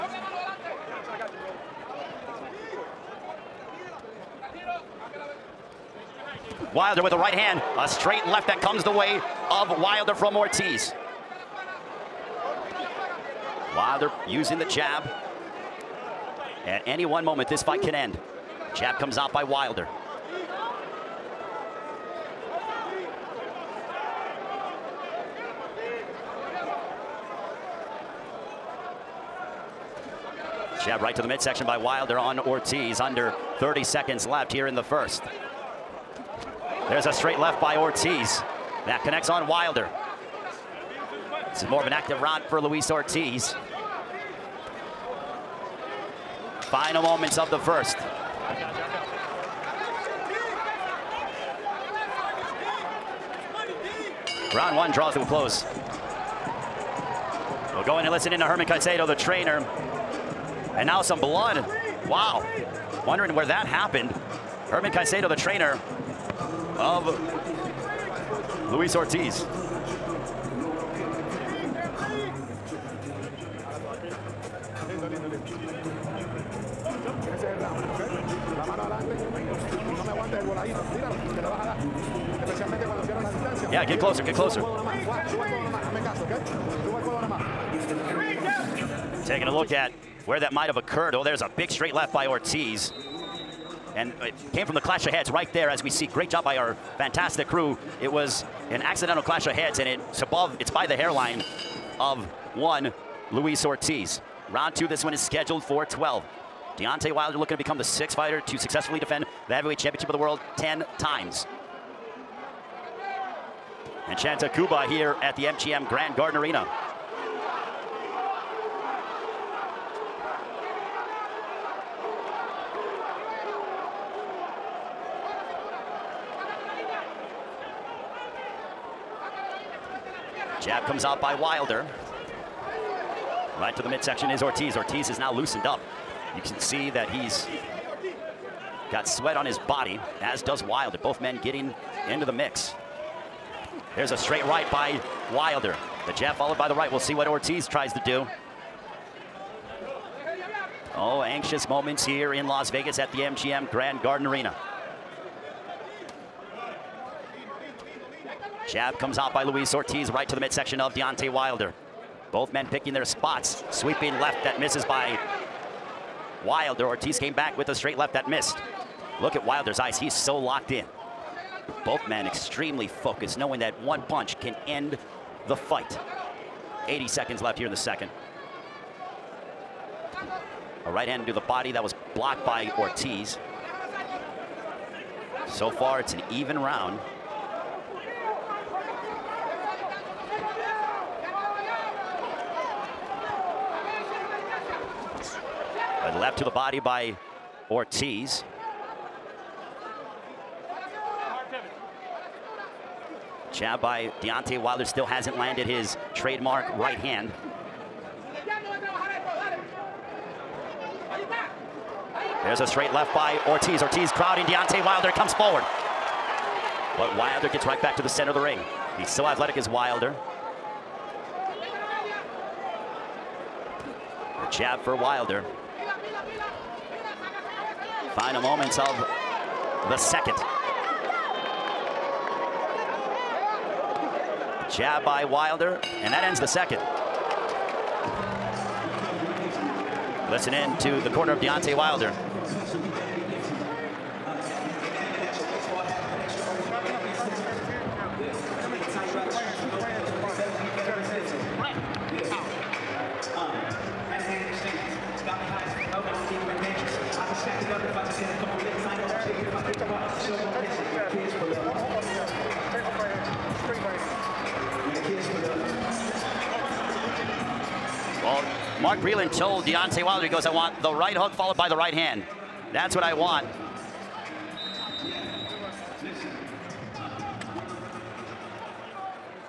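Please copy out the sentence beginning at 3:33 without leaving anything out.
Ortiz crowding Deontay Wilder comes forward.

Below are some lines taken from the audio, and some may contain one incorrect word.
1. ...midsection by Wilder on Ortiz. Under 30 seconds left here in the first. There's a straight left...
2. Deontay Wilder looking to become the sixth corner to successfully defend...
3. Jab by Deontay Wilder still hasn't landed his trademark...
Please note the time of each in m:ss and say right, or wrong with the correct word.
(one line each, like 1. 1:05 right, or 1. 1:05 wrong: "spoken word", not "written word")
1. 0:31 right
2. 1:46 wrong: "fighter", not "corner"
3. 3:23 right.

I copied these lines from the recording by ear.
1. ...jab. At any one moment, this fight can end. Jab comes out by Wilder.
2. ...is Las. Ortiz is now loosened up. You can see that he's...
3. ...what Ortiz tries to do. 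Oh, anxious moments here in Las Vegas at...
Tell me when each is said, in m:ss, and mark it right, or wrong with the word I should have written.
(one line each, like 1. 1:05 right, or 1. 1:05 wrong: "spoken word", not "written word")
1. 0:14 right
2. 2:14 wrong: "Ortiz", not "Las"
3. 2:27 right.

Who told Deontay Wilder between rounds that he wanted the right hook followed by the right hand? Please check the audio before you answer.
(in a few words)
Mark Breland.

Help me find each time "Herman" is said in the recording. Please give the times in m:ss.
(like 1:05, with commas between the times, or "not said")
0:58, 1:04.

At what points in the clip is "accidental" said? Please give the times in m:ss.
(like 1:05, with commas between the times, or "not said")
1:38.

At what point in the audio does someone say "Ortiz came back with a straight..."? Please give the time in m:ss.
2:46.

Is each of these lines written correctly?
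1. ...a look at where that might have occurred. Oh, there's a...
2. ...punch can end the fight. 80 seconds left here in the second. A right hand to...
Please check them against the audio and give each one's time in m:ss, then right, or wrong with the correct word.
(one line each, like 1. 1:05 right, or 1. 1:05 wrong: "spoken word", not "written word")
1. 1:29 right
2. 2:54 right.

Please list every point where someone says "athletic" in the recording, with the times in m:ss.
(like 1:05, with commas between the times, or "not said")
3:39.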